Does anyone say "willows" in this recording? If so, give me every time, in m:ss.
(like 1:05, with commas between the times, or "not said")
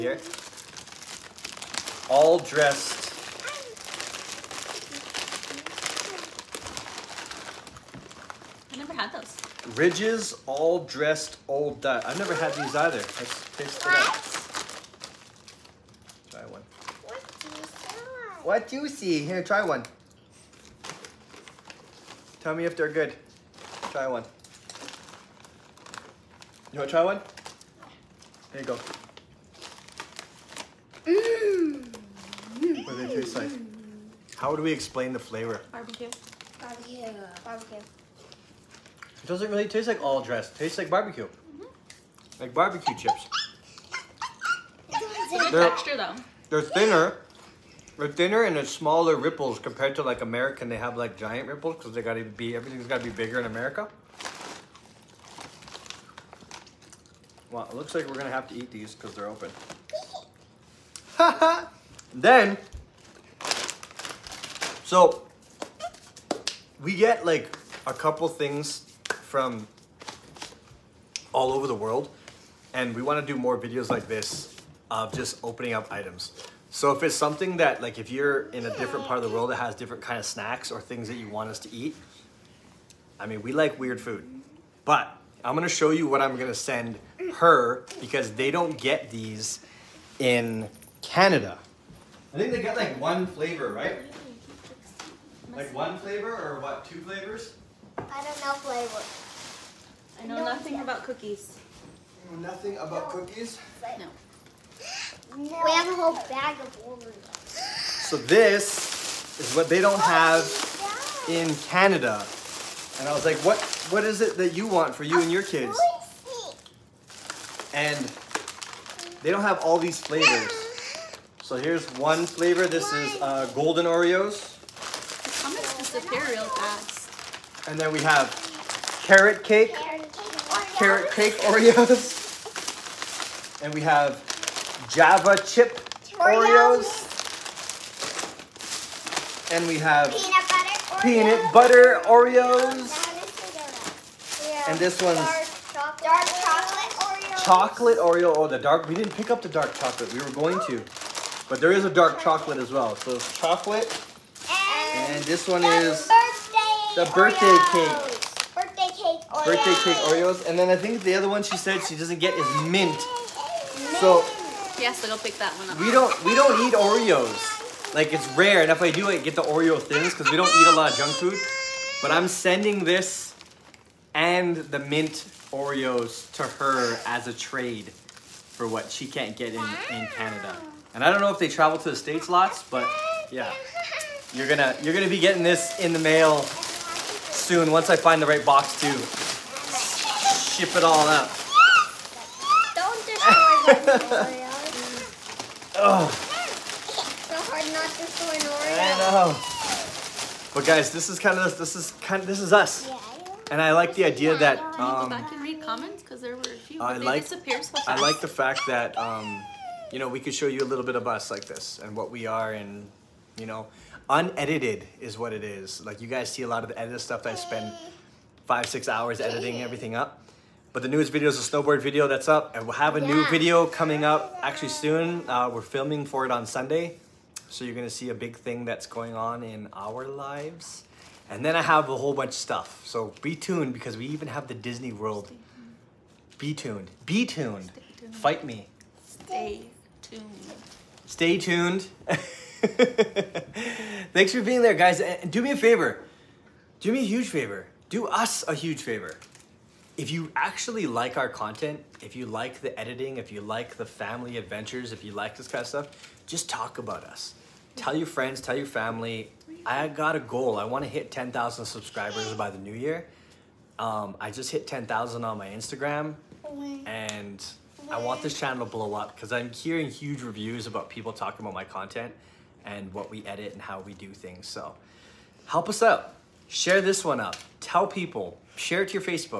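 not said.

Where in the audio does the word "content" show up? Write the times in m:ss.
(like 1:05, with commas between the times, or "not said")
4:11, 4:31.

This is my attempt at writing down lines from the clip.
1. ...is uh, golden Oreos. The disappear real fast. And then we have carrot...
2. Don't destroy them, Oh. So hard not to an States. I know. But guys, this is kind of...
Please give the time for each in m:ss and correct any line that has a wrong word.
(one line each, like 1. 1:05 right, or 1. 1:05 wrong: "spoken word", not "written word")
1. 2:02 right
2. 3:12 wrong: "Oreo", not "States".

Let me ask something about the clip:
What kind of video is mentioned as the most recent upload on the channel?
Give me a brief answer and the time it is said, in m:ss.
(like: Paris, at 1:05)
Snowboard video, at 3:41.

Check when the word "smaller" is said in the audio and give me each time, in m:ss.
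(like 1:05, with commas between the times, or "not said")
0:48.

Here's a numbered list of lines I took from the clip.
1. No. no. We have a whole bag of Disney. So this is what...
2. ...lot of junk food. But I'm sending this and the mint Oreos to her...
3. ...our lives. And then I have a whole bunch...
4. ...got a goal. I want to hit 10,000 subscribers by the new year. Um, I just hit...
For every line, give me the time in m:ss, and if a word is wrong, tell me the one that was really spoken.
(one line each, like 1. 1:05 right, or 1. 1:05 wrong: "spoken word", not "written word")
1. 1:43 wrong: "Oreos", not "Disney"
2. 2:50 right
3. 3:49 right
4. 4:19 right.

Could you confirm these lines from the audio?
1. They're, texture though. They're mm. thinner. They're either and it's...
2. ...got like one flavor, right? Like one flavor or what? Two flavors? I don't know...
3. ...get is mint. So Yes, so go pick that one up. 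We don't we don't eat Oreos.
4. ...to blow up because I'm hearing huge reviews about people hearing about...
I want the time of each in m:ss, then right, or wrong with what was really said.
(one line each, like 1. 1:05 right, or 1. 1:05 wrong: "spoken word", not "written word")
1. 0:45 wrong: "thinner", not "either"
2. 1:32 right
3. 2:42 right
4. 4:28 wrong: "talking", not "hearing".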